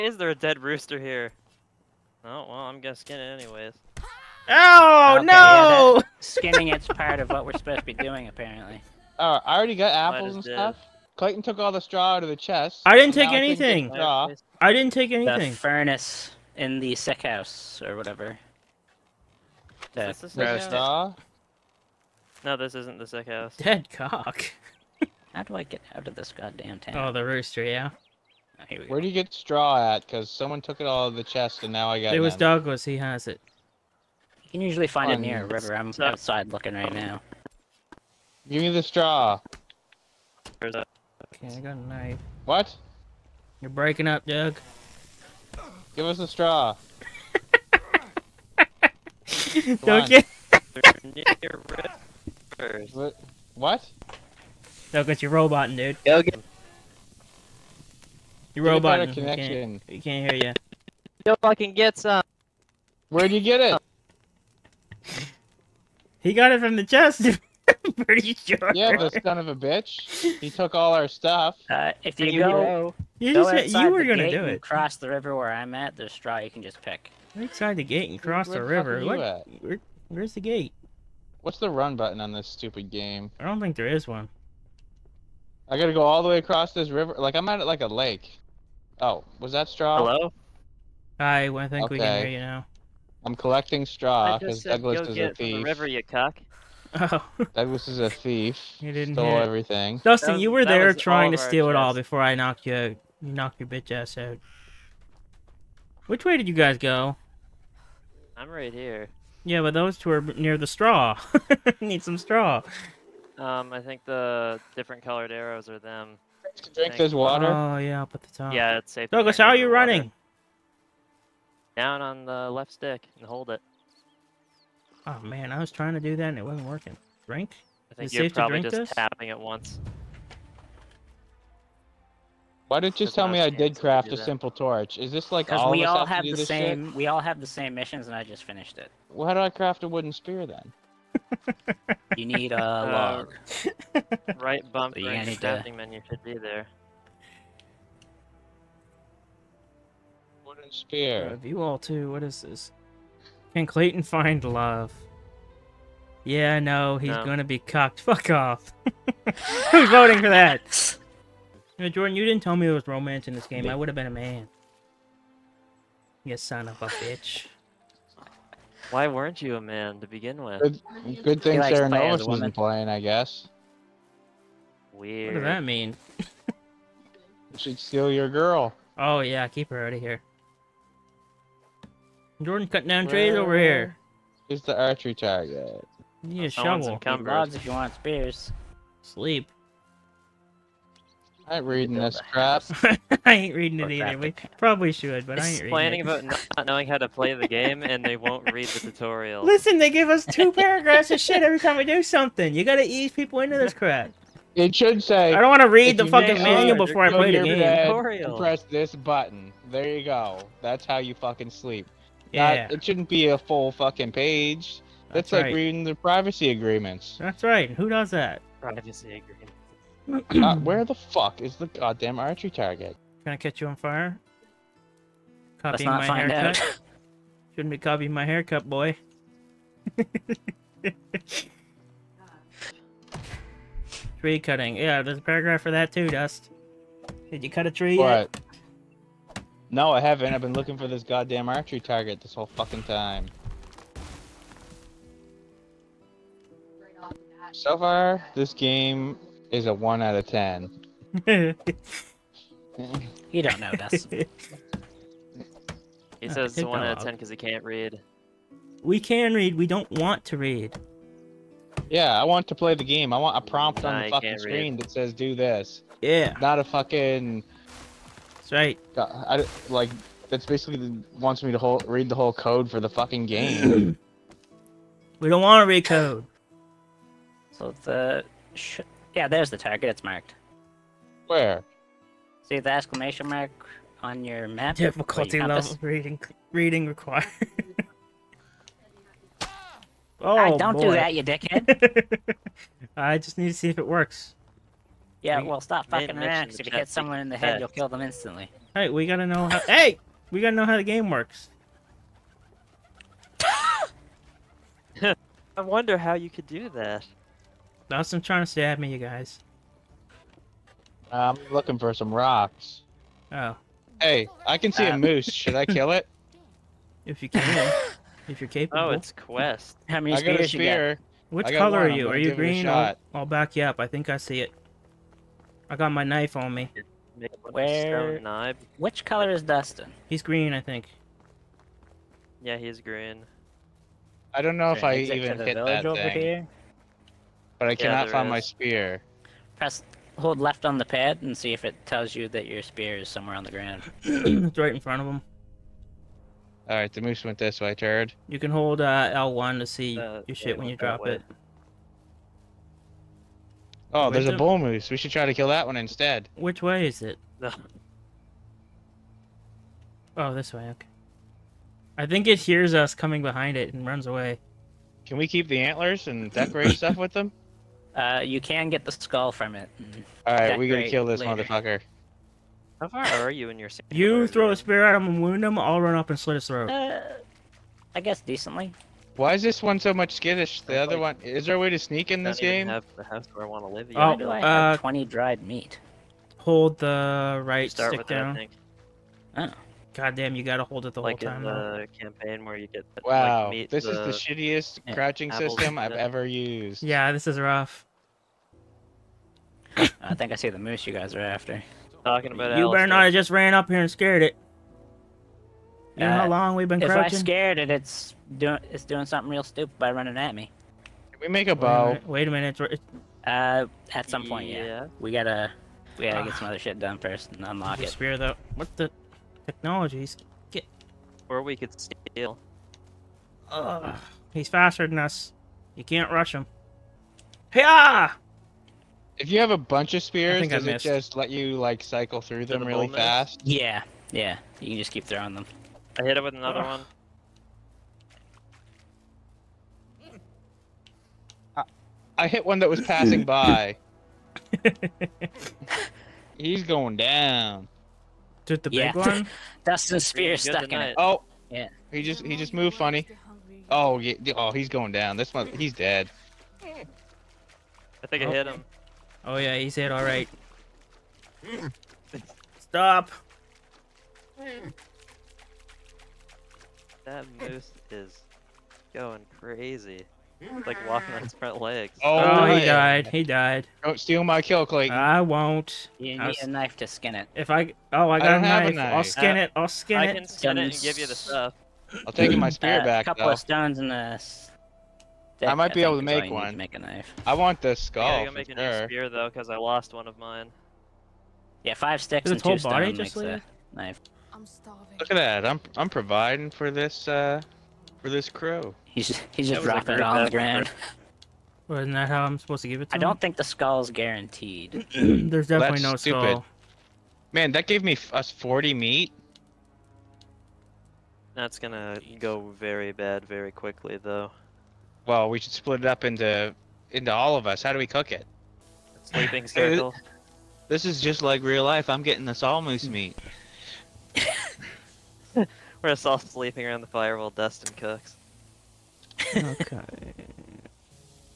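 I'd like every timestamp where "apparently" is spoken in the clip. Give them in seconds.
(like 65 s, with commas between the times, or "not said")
8 s.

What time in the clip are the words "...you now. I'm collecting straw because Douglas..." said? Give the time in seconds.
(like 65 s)
92 s.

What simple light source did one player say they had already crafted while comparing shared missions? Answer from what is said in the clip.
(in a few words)
Simple torch.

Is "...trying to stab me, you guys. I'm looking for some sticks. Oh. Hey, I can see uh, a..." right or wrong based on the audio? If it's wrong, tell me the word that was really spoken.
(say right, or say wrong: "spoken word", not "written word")
wrong: "rocks", not "sticks".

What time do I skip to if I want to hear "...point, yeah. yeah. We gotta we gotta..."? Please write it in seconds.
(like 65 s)
414 s.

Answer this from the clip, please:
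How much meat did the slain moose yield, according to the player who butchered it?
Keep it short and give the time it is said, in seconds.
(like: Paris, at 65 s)
40, at 508 s.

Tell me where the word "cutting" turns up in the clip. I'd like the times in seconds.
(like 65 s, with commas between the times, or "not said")
182 s, 234 s.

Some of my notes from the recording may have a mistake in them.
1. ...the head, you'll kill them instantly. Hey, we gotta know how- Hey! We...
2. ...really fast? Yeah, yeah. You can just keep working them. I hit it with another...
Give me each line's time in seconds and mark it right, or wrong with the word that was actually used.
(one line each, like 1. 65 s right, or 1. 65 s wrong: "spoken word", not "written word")
1. 297 s right
2. 432 s wrong: "throwing", not "working".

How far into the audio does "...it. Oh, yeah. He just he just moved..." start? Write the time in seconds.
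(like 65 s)
450 s.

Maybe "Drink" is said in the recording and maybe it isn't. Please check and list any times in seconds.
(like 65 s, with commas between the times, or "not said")
116 s, 127 s.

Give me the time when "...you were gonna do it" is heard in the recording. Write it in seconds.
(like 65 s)
73 s.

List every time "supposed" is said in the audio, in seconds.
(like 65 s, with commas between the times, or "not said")
7 s, 502 s.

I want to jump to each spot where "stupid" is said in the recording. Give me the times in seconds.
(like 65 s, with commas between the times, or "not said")
82 s, 409 s, 505 s.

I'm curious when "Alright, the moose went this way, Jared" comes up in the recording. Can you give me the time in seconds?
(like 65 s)
346 s.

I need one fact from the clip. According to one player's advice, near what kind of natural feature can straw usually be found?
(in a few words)
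A river.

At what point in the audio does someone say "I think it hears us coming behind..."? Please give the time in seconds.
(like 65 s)
361 s.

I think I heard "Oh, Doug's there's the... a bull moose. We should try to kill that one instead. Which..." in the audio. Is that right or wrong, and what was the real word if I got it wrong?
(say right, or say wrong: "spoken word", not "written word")
wrong: "Where", not "Doug".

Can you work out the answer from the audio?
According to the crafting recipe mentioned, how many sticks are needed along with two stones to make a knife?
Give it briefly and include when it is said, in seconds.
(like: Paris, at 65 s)
5, at 491 s.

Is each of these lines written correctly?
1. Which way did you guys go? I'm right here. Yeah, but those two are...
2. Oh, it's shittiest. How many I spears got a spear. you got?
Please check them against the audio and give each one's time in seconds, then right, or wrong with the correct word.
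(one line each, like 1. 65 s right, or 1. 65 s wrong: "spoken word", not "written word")
1. 106 s right
2. 318 s wrong: "quest", not "shittiest".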